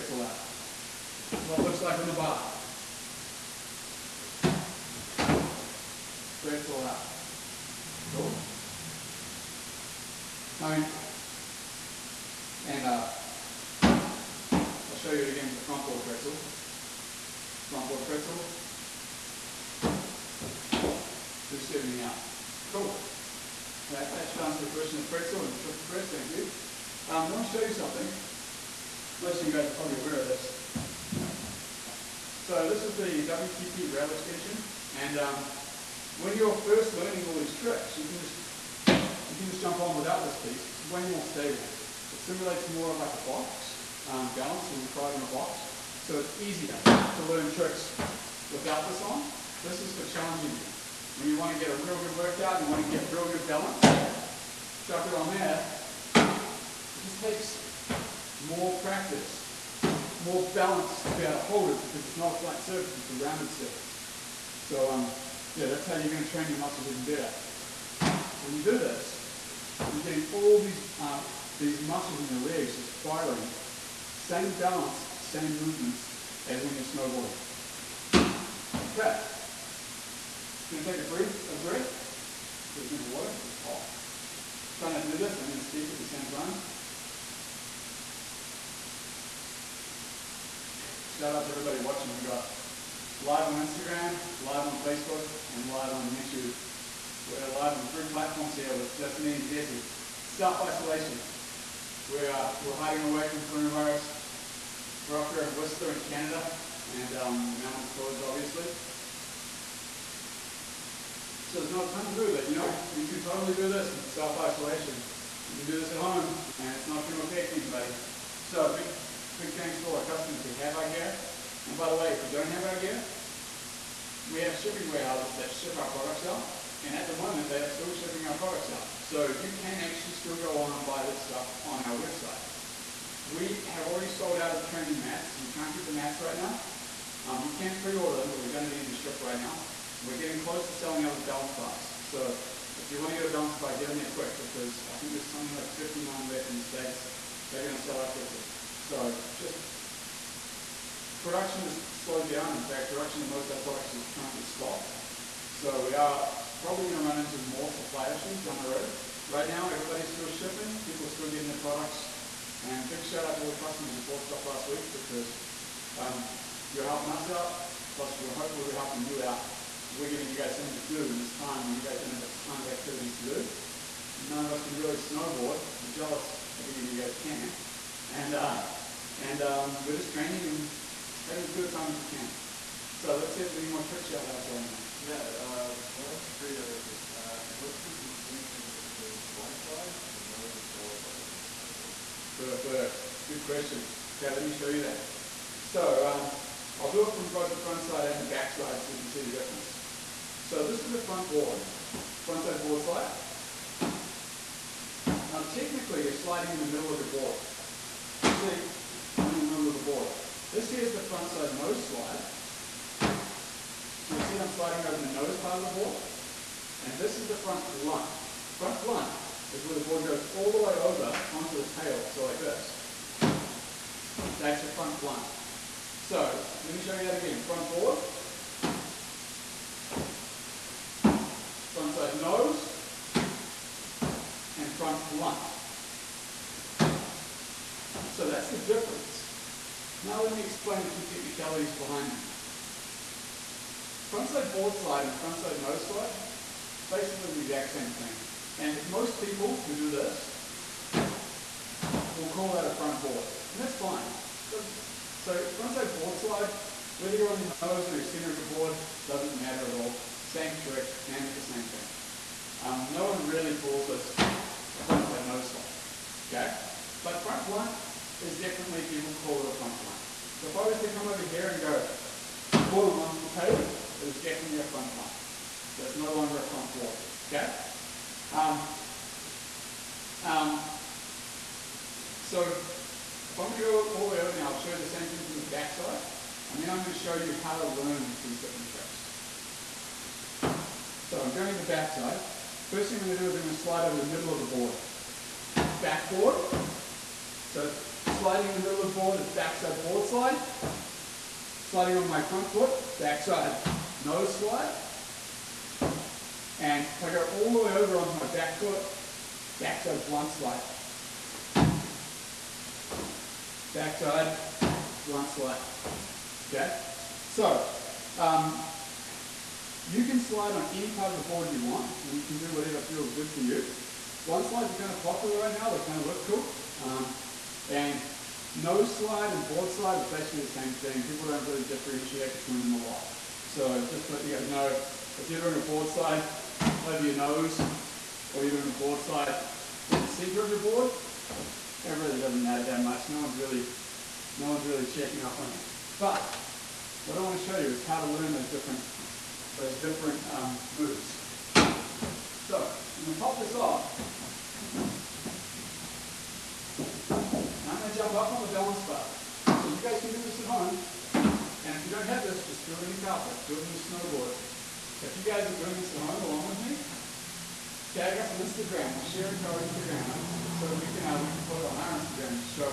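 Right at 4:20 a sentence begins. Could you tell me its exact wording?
Same trick, name it the same thing.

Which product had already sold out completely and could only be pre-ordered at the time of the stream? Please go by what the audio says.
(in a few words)
training mats.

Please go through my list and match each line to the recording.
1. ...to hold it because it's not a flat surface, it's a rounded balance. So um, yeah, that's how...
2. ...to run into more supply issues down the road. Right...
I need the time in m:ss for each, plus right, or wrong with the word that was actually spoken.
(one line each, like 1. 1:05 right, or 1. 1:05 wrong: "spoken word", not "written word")
1. 1:01 wrong: "surface", not "balance"
2. 2:37 right.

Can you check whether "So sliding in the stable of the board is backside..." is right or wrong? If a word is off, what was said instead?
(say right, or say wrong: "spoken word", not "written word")
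wrong: "middle", not "stable".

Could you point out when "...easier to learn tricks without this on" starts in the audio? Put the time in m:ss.
0:46.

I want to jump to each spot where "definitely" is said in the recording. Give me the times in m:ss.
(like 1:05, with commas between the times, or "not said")
4:28, 4:34.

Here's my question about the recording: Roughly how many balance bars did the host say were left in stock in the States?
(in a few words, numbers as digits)
59.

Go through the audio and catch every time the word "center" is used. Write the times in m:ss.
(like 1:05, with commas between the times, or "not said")
4:18, 5:40.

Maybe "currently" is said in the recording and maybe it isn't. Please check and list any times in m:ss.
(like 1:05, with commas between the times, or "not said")
2:34.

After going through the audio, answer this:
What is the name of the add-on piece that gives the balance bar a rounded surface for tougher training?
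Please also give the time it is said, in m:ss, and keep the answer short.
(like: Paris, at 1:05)
WTP rail extension, at 0:33.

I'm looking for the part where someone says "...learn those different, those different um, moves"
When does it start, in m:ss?
5:48.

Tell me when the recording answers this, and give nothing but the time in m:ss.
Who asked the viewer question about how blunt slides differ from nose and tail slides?
3:05.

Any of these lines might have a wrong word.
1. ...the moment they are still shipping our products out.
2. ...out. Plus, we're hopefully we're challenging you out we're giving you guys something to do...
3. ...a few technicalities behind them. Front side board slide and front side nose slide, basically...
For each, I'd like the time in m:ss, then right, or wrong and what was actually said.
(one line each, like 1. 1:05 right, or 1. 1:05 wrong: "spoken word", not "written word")
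1. 2:07 right
2. 2:47 wrong: "helping", not "challenging"
3. 4:00 right.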